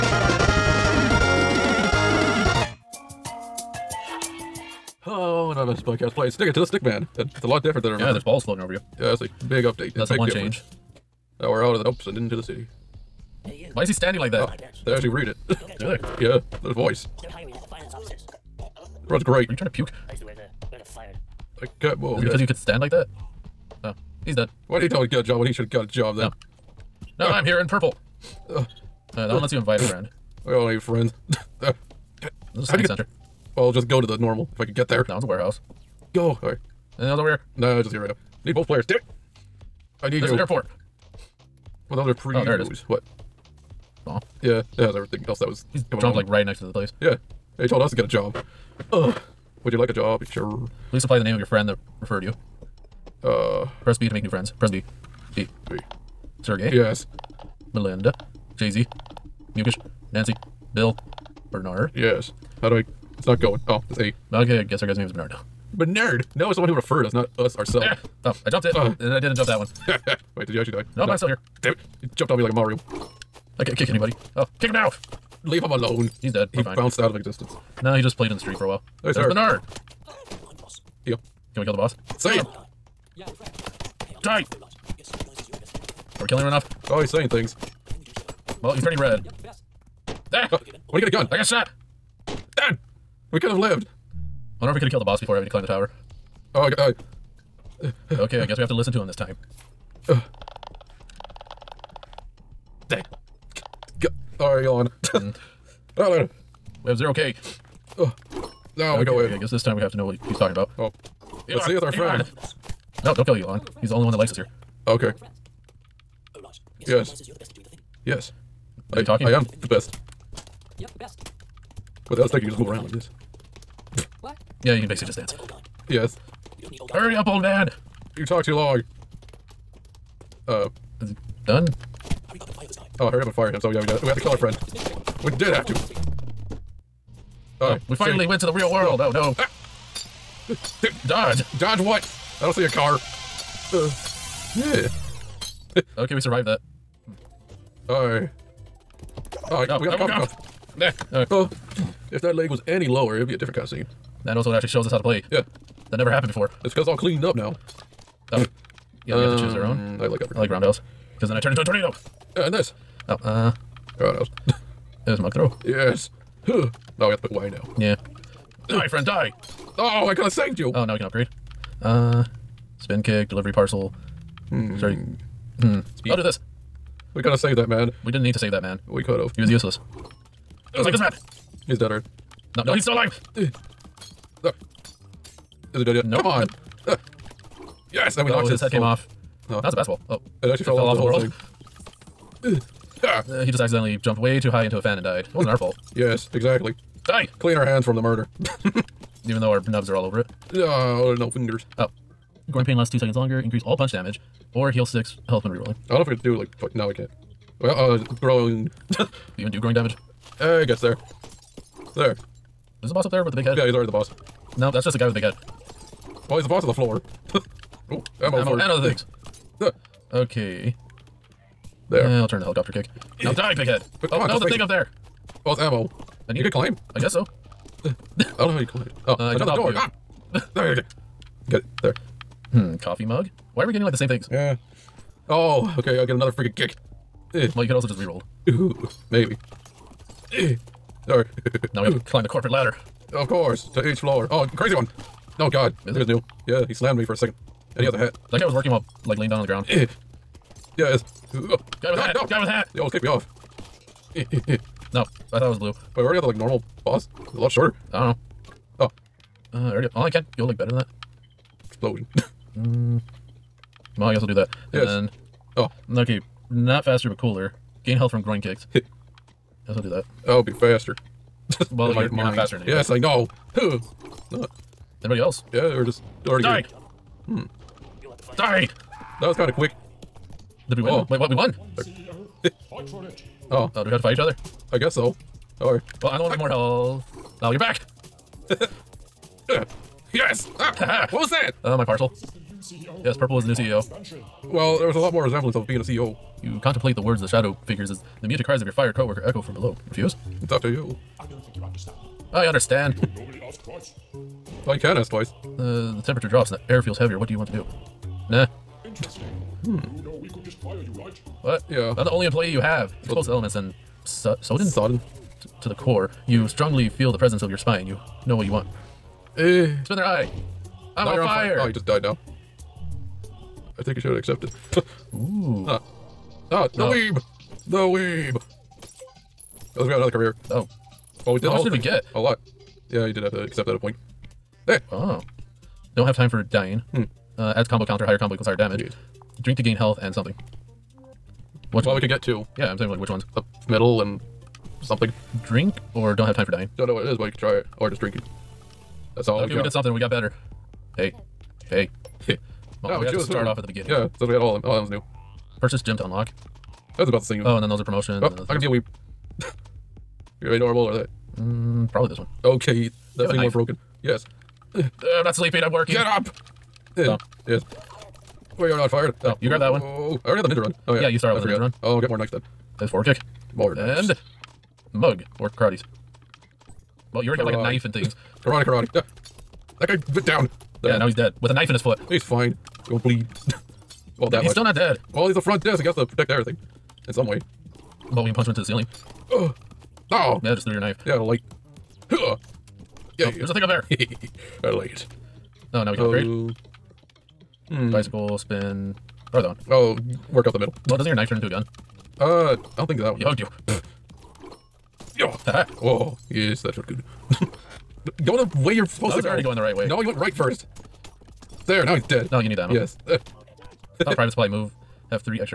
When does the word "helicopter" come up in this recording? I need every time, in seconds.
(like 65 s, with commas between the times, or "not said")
222 s.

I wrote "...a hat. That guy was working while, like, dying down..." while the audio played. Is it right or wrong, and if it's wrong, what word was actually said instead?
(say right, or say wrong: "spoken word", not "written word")
wrong: "laying", not "dying".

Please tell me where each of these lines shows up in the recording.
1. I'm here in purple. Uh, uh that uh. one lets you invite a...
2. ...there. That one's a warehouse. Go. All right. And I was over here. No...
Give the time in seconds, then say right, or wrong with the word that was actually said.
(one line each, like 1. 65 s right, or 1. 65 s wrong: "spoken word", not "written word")
1. 27 s right
2. 34 s right.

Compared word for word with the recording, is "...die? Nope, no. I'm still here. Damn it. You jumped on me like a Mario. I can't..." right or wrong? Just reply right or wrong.
right.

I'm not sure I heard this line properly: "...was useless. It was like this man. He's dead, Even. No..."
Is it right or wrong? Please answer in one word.
wrong.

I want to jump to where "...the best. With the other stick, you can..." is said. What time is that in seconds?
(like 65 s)
120 s.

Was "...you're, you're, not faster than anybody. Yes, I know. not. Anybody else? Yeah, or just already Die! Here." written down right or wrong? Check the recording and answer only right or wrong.
right.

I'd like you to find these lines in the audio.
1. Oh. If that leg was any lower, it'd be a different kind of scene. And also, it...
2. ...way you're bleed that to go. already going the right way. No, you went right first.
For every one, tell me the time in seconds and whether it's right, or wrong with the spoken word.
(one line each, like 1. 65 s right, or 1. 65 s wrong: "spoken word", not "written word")
1. 151 s right
2. 408 s wrong: "supposed", not "bleed".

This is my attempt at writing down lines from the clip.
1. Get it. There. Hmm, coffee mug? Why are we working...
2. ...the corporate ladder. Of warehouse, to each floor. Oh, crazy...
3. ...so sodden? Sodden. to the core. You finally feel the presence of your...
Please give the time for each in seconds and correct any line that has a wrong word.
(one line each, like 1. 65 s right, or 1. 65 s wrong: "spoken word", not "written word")
1. 231 s wrong: "getting", not "working"
2. 242 s wrong: "course", not "warehouse"
3. 314 s wrong: "strongly", not "finally".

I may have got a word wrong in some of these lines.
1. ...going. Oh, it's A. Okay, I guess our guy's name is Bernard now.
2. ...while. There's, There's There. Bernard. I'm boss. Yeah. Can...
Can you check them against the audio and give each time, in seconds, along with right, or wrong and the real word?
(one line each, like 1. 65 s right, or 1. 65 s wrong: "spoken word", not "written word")
1. 63 s right
2. 78 s wrong: "Bernard", not "There".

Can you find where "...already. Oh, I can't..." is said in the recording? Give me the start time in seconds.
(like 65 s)
259 s.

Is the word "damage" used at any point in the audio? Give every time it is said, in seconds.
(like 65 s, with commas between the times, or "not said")
203 s, 209 s, 338 s.